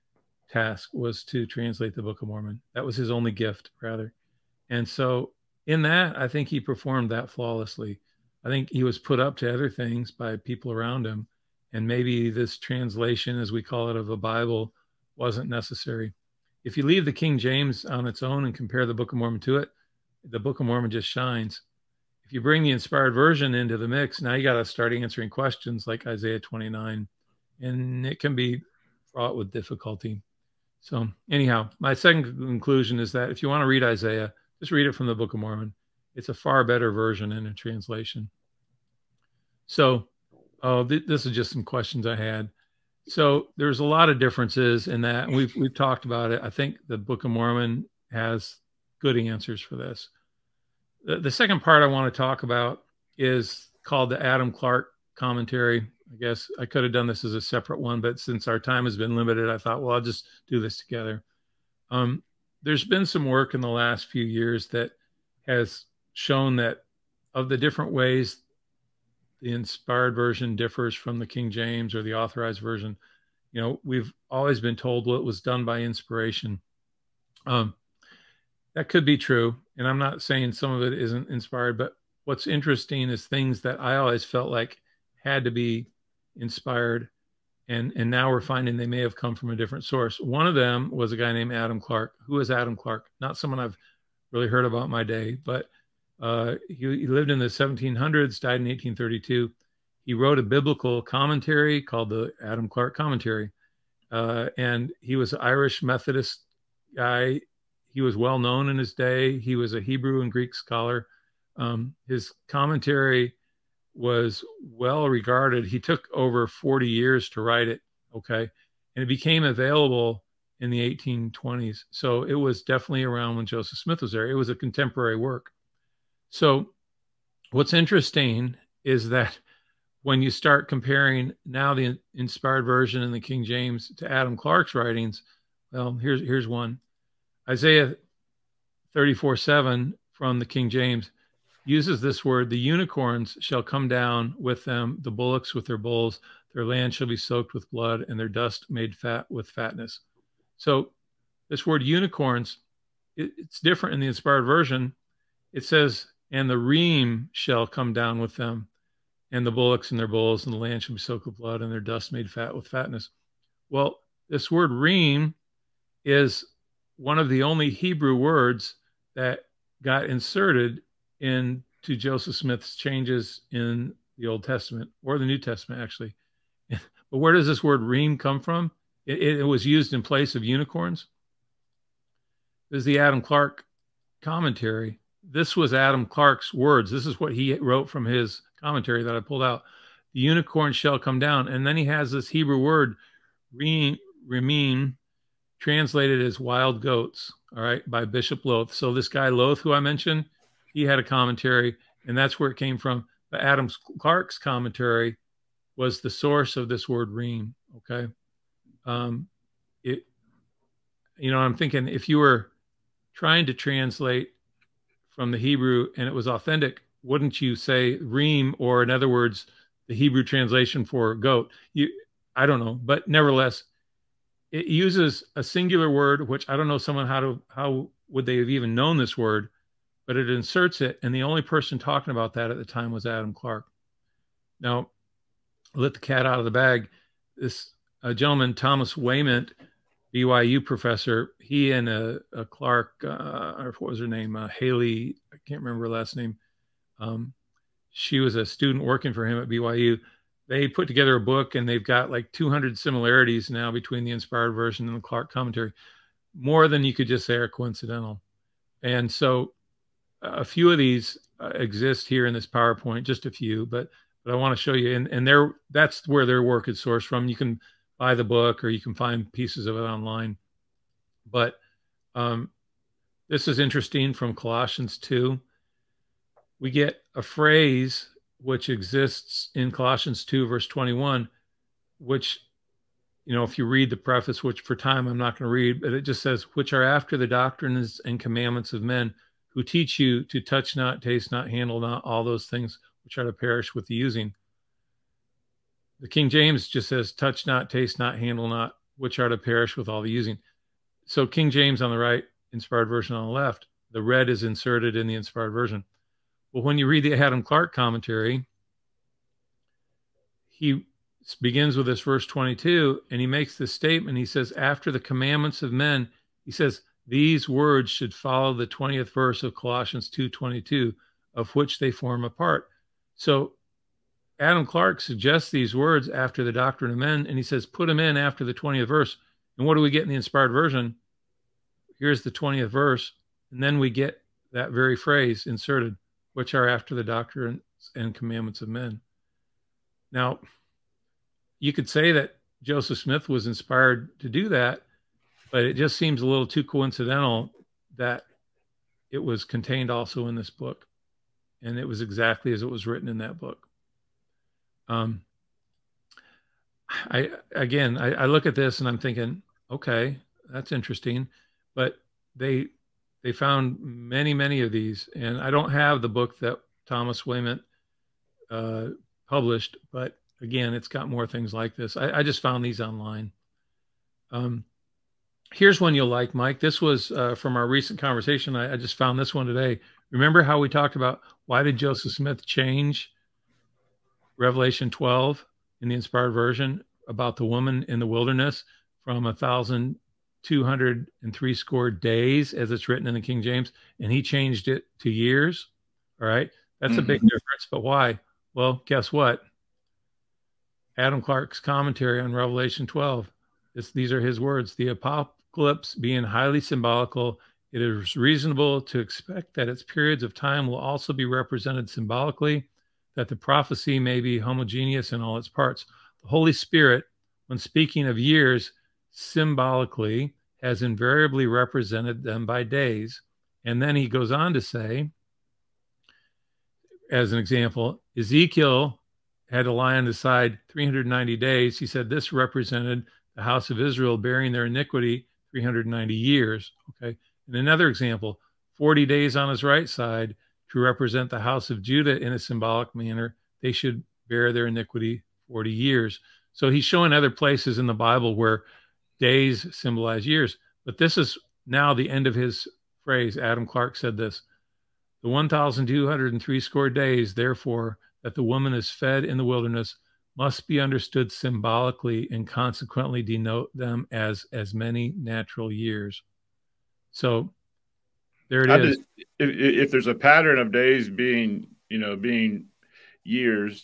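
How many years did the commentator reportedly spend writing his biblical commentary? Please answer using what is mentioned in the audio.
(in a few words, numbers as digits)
Over 40 years.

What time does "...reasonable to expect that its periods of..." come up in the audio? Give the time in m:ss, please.
6:48.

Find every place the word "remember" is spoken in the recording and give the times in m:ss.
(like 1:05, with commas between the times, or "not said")
4:05, 6:20.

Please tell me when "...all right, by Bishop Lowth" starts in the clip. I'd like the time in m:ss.
3:17.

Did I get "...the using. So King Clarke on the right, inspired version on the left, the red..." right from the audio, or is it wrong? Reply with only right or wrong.
wrong.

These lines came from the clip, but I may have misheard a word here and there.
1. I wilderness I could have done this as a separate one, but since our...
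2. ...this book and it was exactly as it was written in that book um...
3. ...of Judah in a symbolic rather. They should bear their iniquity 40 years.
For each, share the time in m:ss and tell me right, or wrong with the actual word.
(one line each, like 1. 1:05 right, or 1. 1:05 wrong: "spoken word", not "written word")
1. 0:56 wrong: "guess", not "wilderness"
2. 5:50 right
3. 7:21 wrong: "manner", not "rather".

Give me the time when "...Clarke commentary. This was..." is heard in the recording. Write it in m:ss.
3:03.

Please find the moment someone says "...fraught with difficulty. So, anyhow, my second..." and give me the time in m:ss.
0:29.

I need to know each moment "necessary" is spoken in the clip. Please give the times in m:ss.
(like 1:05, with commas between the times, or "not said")
0:15.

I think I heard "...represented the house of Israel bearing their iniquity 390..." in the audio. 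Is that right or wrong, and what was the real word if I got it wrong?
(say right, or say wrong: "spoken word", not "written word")
right.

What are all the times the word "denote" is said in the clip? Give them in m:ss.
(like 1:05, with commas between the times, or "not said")
7:43.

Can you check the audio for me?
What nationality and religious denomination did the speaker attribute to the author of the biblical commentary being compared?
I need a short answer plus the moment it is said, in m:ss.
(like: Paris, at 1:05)
Irish Methodist, at 1:45.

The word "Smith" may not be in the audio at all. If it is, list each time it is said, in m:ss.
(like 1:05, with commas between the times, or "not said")
2:03, 2:52, 5:42, 6:22.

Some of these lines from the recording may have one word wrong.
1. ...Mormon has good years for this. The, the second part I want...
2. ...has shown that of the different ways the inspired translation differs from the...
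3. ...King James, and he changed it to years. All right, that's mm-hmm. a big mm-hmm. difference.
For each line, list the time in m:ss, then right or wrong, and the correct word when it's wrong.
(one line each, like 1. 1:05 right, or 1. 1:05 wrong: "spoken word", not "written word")
1. 0:47 wrong: "answers", not "years"
2. 1:05 wrong: "version", not "translation"
3. 6:33 right.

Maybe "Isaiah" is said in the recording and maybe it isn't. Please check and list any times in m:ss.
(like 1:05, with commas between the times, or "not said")
0:26, 0:33, 2:17.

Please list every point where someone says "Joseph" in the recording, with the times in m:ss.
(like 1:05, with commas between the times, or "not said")
2:03, 2:51, 5:42, 6:21.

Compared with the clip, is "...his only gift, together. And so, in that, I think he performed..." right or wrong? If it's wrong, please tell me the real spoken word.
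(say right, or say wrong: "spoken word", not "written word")
wrong: "rather", not "together".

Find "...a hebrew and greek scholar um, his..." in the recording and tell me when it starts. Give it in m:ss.
1:49.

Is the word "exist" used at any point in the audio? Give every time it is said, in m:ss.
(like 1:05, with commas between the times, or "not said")
4:21, 4:38.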